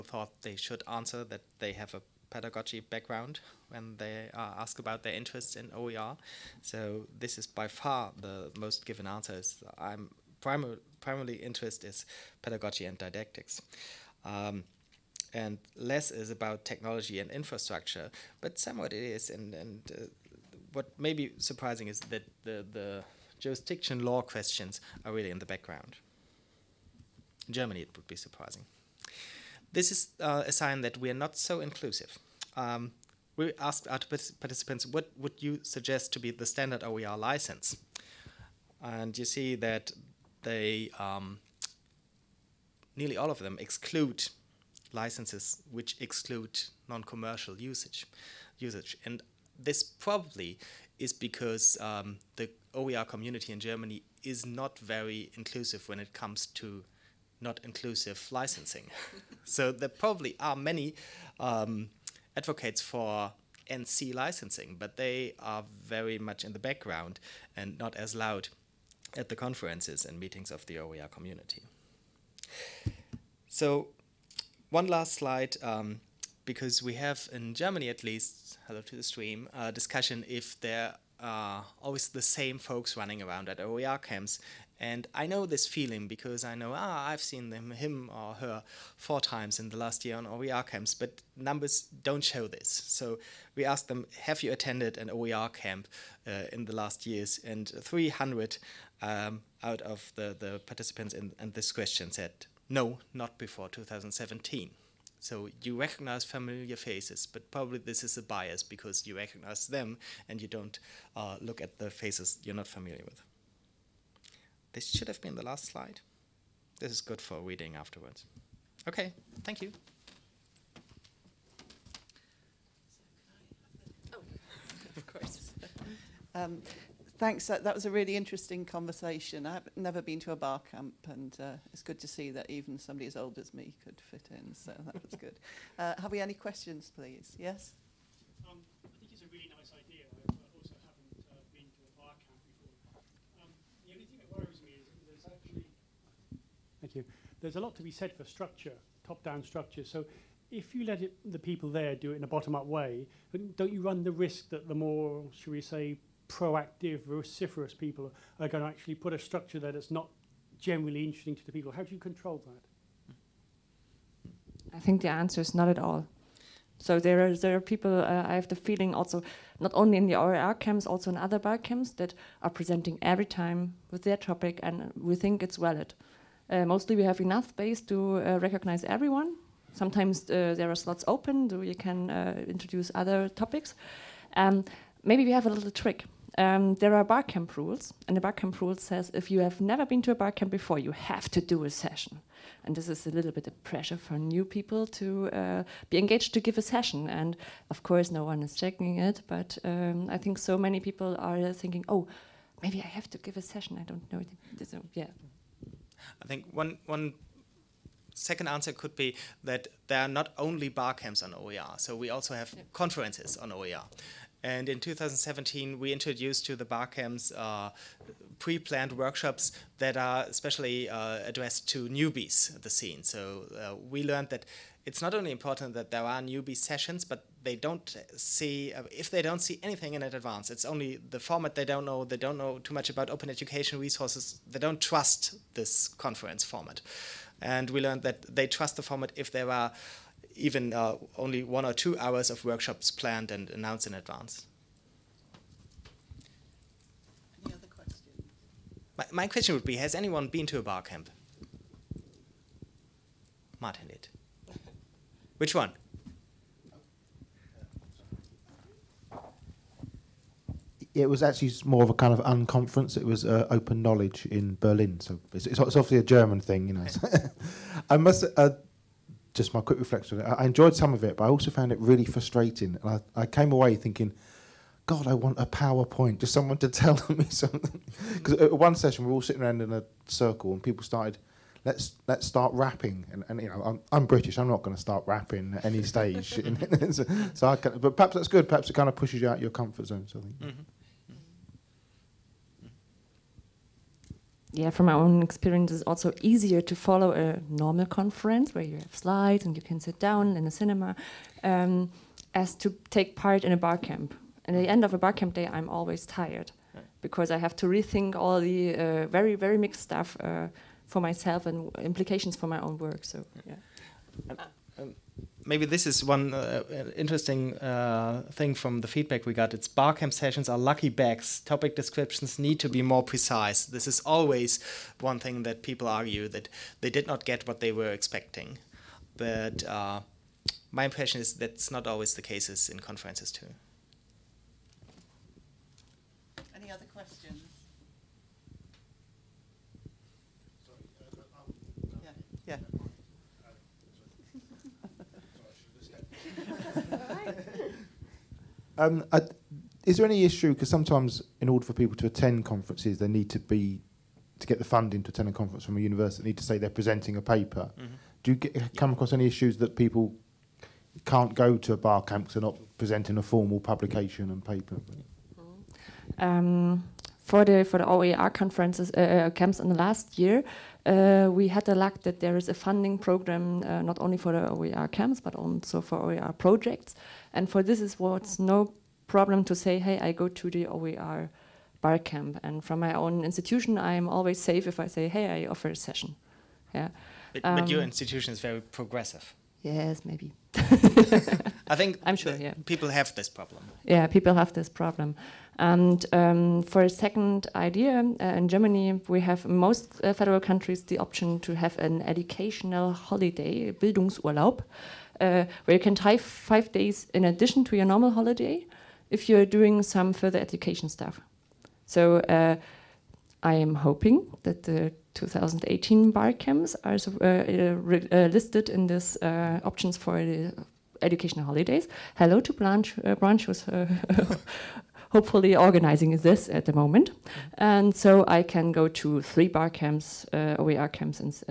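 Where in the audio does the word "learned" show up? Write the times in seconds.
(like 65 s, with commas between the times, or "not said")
224 s, 237 s.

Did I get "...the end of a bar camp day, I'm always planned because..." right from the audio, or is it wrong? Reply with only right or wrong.
wrong.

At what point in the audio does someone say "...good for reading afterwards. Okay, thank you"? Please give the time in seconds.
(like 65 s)
117 s.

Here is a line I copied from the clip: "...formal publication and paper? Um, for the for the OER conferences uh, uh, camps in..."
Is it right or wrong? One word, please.
right.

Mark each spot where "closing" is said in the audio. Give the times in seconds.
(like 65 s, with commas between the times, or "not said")
not said.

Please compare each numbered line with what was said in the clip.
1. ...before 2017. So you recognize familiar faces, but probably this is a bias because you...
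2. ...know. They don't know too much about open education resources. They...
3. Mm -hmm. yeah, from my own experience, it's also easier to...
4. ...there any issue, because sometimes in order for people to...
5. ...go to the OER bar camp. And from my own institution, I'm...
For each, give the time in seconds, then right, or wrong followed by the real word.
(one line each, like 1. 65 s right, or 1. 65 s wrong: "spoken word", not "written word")
1. 103 s right
2. 231 s right
3. 290 s right
4. 349 s right
5. 380 s right.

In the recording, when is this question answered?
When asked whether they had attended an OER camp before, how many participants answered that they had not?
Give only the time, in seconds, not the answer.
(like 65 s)
97 s.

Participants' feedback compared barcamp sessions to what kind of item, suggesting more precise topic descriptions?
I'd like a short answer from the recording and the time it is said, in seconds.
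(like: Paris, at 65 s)
Lucky bags, at 320 s.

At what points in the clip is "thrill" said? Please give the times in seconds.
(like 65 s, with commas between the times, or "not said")
not said.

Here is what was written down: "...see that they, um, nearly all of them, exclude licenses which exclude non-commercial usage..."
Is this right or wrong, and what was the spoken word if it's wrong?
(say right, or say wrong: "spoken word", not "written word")
right.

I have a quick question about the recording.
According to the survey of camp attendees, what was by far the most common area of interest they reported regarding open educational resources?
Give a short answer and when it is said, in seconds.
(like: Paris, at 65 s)
Pedagogy and didactics, at 12 s.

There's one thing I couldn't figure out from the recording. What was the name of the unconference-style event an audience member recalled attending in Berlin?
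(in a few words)
Open knowledge.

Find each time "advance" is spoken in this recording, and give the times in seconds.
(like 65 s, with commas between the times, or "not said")
230 s, 243 s.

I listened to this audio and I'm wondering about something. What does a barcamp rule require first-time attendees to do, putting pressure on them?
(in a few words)
Do a session.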